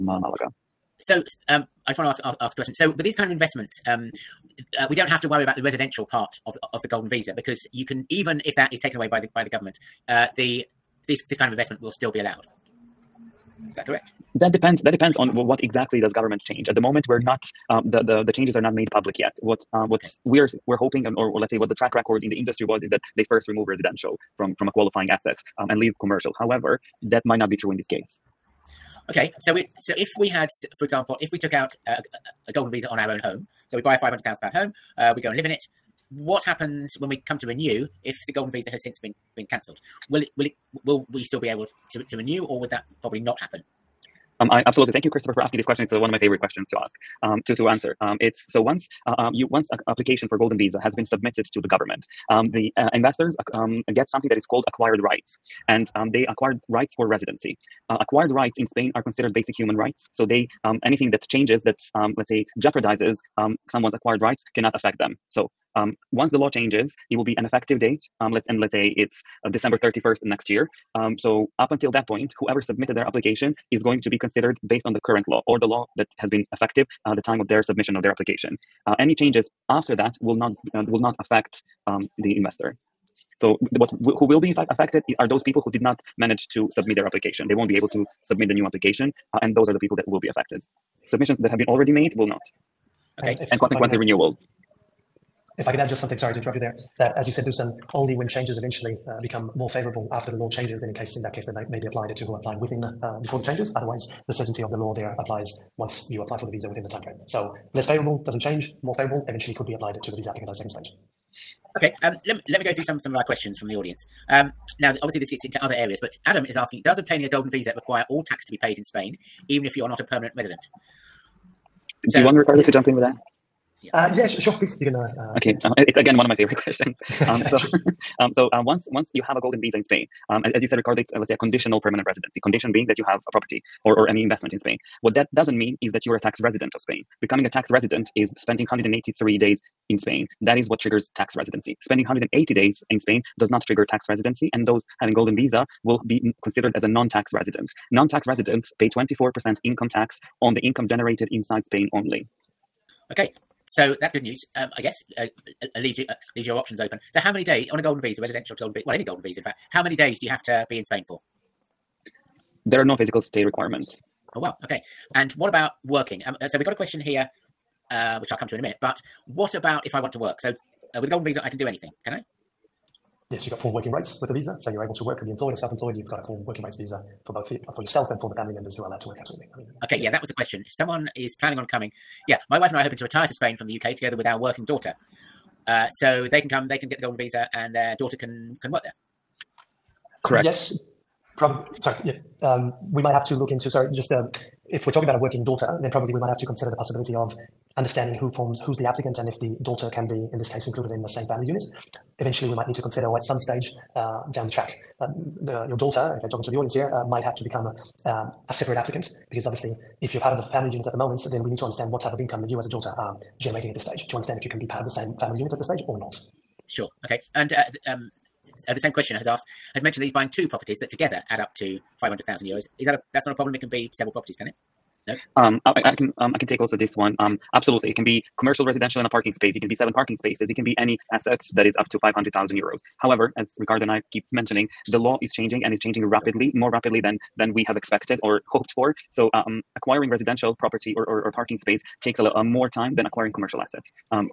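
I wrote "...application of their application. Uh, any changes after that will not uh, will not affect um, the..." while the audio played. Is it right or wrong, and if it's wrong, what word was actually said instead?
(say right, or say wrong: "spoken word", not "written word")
wrong: "submission", not "application".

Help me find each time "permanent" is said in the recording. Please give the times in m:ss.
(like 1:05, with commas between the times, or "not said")
2:00, 2:11.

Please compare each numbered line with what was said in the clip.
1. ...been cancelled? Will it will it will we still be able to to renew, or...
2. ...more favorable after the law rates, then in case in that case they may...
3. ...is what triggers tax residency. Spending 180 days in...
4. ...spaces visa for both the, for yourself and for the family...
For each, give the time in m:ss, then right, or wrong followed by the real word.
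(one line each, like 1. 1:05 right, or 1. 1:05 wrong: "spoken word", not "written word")
1. 0:39 right
2. 1:39 wrong: "changes", not "rates"
3. 2:20 right
4. 2:56 wrong: "rates", not "spaces".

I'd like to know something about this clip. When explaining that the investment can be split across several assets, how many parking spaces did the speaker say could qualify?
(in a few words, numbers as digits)
7.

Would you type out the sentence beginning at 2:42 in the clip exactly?
There are no physical stay requirements.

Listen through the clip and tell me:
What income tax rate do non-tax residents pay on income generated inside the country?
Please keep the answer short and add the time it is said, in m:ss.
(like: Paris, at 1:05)
24%, at 2:28.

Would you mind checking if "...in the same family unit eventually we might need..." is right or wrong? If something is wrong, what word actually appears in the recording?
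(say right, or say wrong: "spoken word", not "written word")
right.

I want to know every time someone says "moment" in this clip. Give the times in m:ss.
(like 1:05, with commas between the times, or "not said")
0:16, 3:30.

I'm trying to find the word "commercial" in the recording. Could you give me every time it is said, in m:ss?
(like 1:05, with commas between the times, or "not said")
0:26, 3:48, 4:03.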